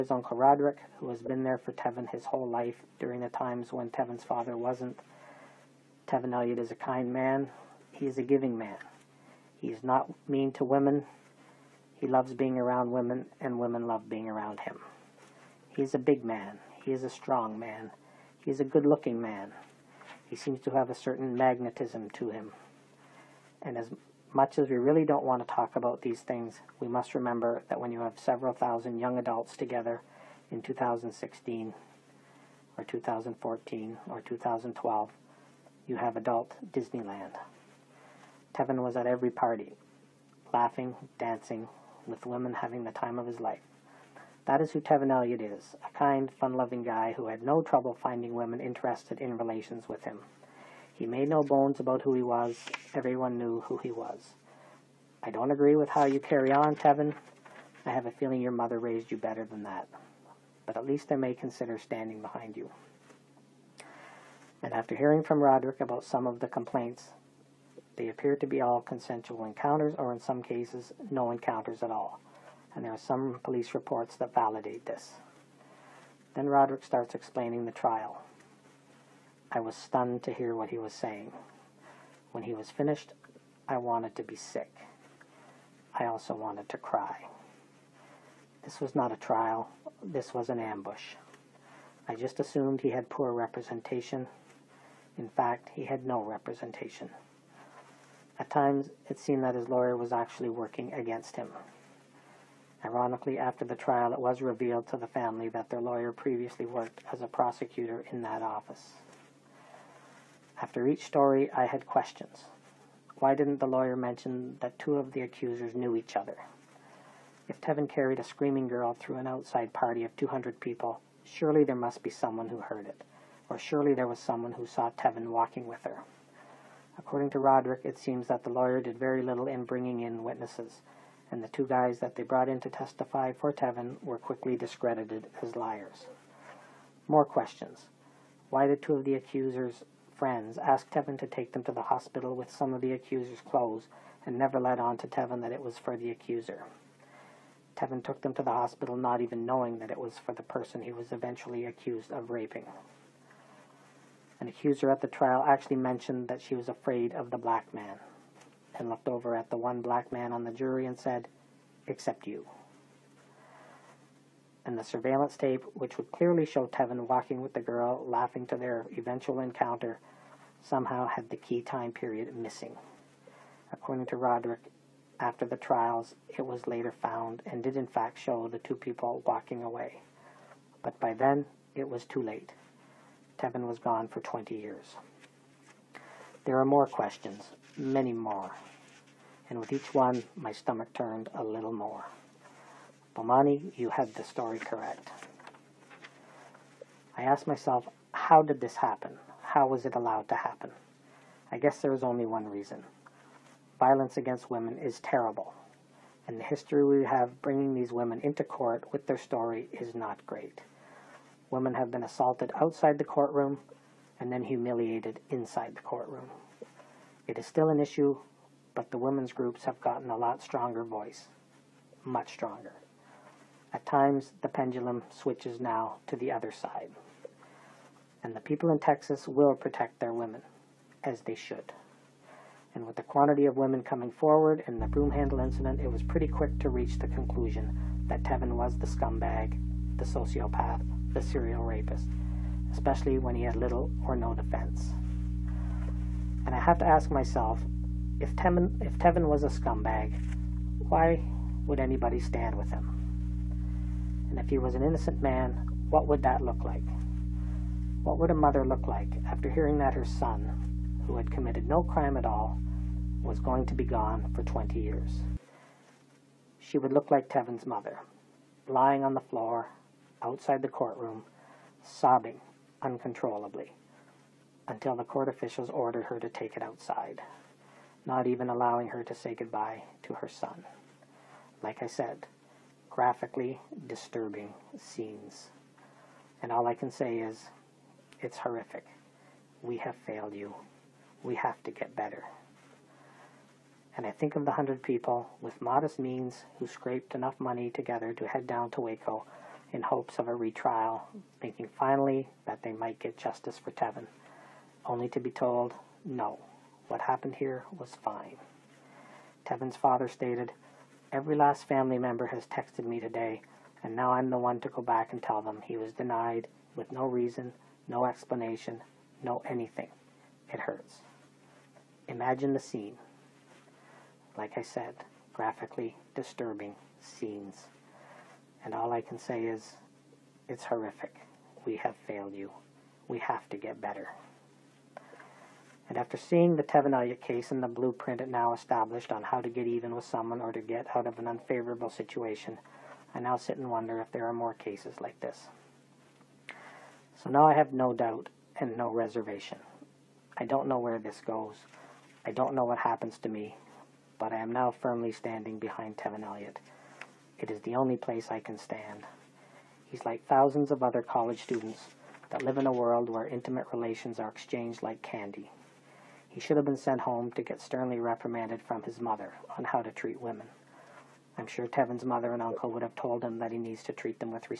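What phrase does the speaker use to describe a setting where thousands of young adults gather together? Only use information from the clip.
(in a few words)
adult Disneyland.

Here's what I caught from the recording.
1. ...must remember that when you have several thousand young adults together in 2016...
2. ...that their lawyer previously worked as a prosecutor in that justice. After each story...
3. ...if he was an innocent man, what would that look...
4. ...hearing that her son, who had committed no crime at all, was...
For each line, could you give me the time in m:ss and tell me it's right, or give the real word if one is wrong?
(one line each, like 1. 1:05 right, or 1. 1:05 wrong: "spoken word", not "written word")
1. 0:26 right
2. 1:45 wrong: "office", not "justice"
3. 4:14 right
4. 4:19 right.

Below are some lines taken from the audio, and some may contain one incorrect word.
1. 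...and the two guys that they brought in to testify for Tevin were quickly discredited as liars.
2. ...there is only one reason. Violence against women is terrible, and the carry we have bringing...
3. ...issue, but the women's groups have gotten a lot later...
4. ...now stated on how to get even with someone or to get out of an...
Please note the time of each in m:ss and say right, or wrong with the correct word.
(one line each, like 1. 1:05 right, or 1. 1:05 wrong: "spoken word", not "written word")
1. 2:11 right
2. 3:21 wrong: "history", not "carry"
3. 3:37 wrong: "stronger", not "later"
4. 5:38 wrong: "established", not "stated".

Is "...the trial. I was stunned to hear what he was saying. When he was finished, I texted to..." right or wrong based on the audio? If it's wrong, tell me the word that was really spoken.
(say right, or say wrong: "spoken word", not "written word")
wrong: "wanted", not "texted".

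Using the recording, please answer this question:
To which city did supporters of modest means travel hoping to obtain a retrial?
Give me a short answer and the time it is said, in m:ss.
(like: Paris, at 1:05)
Waco, at 4:58.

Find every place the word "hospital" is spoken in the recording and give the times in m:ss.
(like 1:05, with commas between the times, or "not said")
2:21, 2:28.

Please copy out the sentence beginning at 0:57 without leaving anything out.
I have a feeling your mother raised you better than that.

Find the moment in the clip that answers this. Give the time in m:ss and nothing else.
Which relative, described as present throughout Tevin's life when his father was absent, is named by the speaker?
0:00.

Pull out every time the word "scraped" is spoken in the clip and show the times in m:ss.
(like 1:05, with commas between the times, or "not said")
4:56.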